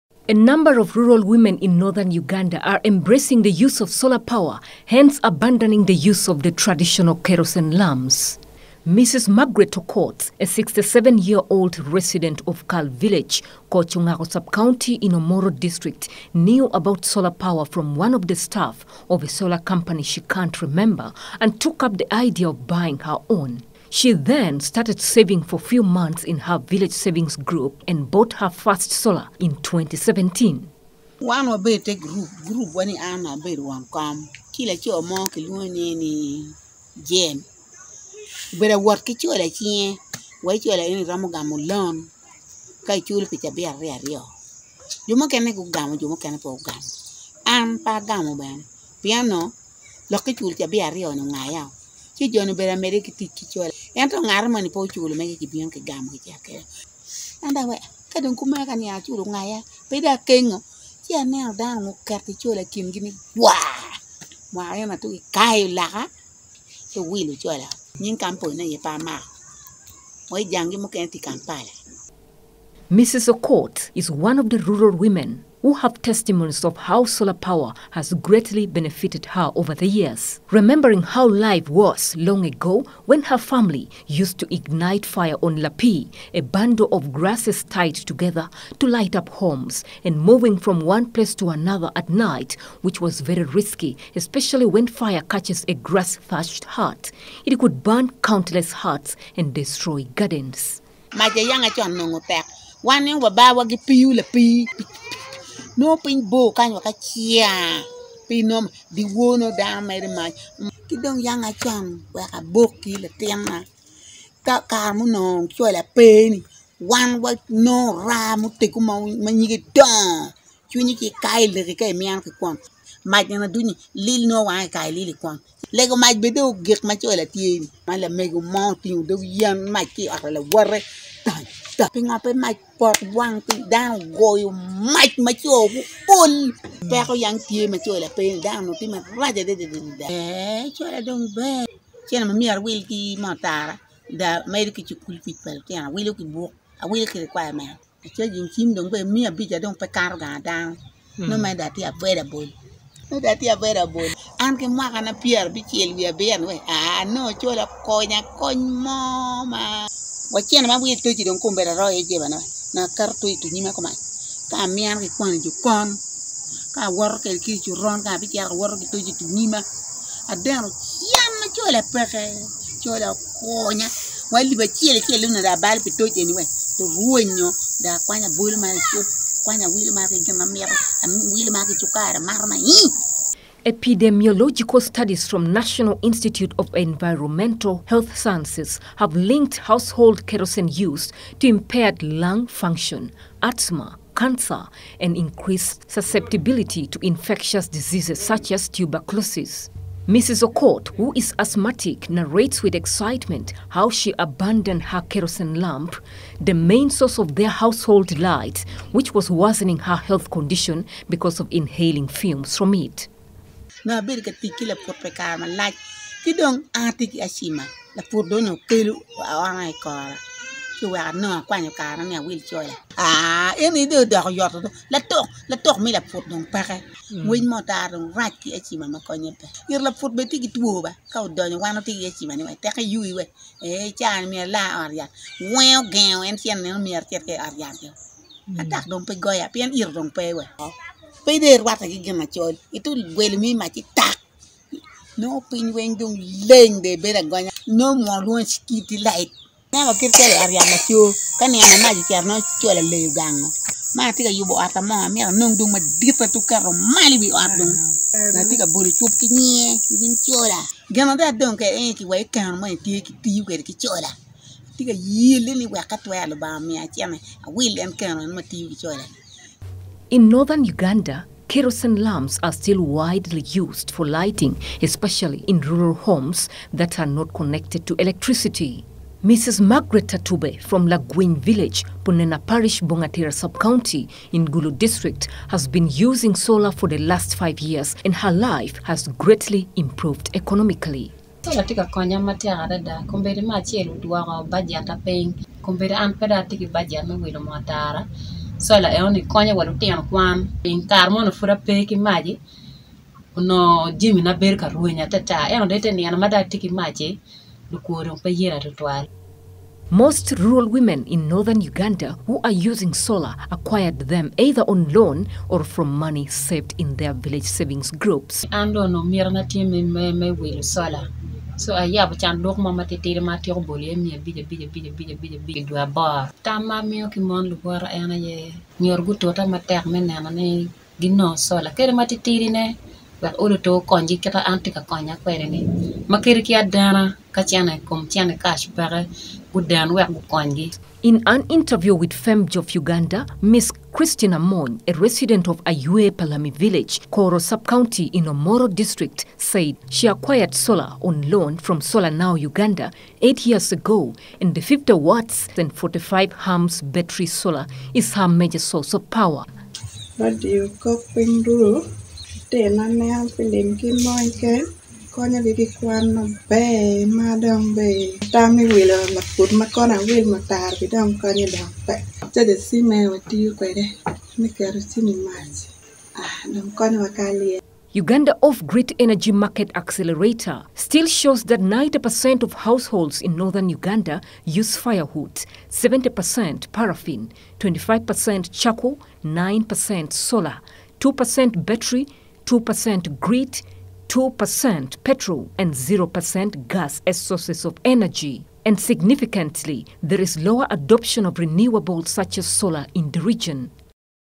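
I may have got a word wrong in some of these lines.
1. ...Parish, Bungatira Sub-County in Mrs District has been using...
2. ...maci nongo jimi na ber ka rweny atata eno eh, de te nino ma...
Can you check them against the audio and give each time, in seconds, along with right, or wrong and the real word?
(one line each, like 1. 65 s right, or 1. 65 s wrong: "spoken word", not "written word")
1. 282 s wrong: "Gulu", not "Mrs"
2. 301 s right.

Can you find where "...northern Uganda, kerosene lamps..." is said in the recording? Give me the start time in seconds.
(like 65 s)
270 s.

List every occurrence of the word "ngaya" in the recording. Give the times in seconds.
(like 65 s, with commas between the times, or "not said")
59 s.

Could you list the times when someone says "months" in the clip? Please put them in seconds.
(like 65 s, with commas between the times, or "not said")
25 s.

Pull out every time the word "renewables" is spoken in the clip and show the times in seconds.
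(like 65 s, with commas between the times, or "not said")
401 s.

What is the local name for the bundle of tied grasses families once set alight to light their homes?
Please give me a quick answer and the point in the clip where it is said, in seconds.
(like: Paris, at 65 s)
lapi, at 85 s.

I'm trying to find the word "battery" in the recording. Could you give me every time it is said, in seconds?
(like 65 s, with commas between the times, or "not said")
356 s, 391 s.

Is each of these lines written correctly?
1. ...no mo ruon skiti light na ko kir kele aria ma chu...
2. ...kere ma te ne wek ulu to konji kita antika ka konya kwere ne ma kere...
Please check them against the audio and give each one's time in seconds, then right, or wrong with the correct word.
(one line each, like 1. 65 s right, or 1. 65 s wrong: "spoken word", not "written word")
1. 247 s right
2. 331 s right.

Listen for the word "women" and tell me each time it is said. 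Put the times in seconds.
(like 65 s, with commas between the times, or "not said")
1 s, 74 s, 310 s.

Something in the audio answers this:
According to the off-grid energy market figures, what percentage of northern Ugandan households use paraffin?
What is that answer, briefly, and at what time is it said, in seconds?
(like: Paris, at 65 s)
70%, at 385 s.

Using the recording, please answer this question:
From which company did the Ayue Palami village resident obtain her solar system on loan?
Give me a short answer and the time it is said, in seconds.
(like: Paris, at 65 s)
Solar Now Uganda, at 351 s.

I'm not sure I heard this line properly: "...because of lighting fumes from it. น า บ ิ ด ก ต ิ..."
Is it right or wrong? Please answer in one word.
wrong.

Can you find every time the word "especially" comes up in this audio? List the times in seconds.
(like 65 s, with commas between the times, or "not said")
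94 s, 274 s.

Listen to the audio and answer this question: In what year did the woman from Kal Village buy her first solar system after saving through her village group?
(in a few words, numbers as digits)
2017.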